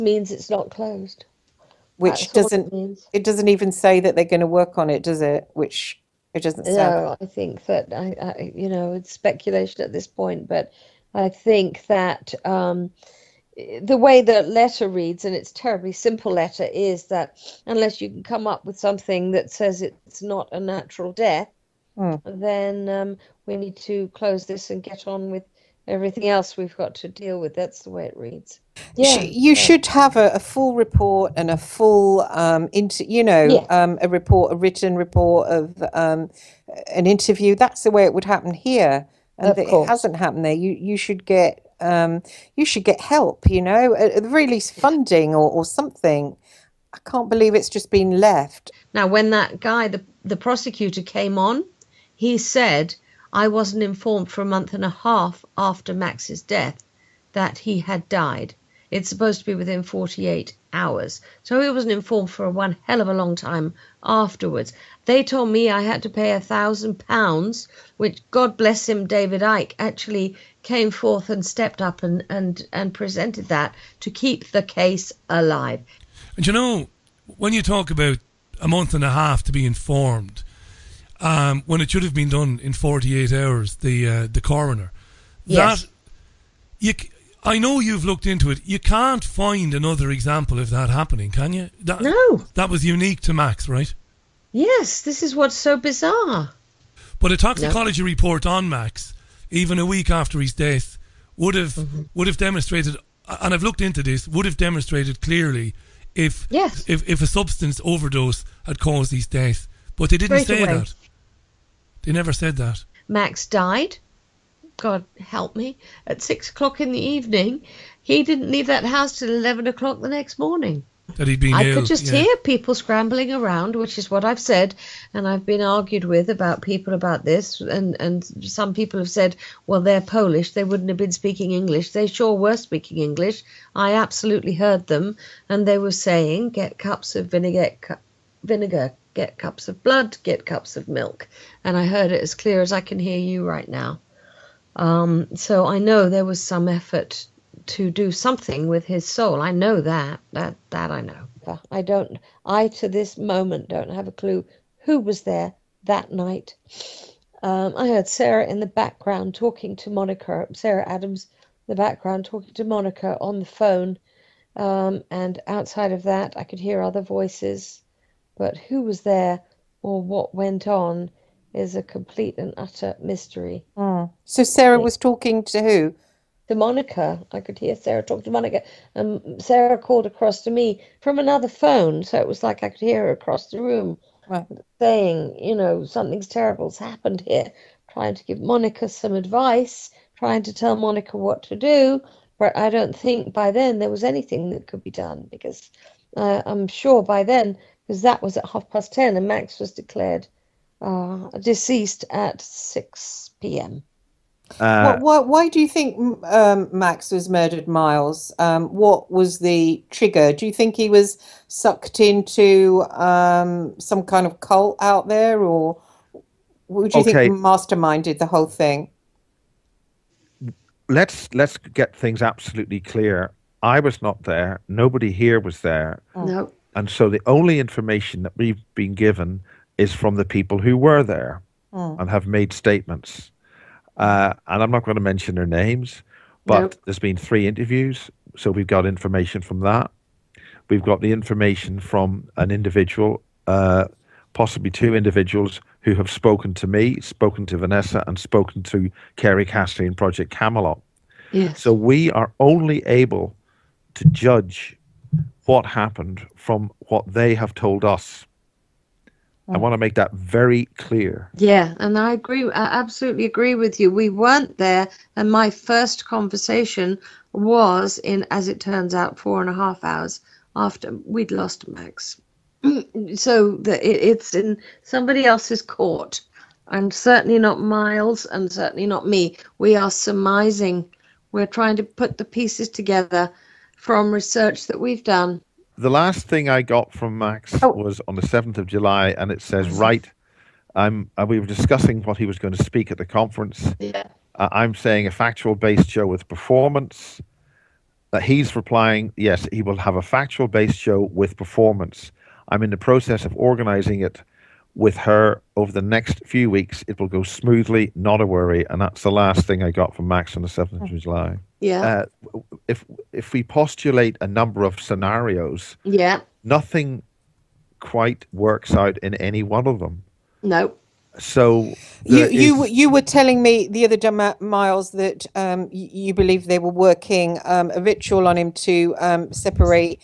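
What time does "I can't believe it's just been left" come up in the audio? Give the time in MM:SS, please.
00:46.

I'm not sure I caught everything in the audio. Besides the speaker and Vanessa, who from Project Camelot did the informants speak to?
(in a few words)
Kerry Cassidy.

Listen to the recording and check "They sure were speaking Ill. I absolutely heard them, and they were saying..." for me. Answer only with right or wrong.
wrong.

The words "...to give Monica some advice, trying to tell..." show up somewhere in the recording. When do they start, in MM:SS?
03:08.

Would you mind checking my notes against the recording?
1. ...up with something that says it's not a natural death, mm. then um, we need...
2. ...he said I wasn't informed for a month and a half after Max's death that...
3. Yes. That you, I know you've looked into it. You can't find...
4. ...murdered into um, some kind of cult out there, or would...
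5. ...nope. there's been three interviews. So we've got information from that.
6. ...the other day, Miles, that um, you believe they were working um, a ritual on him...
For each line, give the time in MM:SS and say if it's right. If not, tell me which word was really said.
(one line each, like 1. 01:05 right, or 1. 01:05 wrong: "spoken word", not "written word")
1. 00:18 right
2. 00:52 right
3. 01:25 right
4. 03:31 wrong: "sucked", not "murdered"
5. 03:56 right
6. 05:23 right.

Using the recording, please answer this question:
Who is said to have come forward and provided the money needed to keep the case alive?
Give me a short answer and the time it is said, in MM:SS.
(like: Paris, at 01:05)
David Icke, at 01:09.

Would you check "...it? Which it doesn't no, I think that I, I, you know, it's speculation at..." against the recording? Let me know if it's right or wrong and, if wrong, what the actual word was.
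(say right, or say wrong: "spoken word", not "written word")
right.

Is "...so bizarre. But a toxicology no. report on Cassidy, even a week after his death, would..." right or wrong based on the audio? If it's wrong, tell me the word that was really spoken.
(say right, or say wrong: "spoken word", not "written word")
wrong: "Max", not "Cassidy".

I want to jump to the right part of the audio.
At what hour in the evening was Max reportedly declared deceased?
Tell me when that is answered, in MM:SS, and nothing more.
01:56.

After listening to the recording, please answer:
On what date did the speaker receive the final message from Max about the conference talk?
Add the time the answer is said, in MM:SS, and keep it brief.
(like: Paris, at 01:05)
7th of July, at 04:48.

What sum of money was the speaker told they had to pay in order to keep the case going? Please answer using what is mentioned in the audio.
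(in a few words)
1000 pounds.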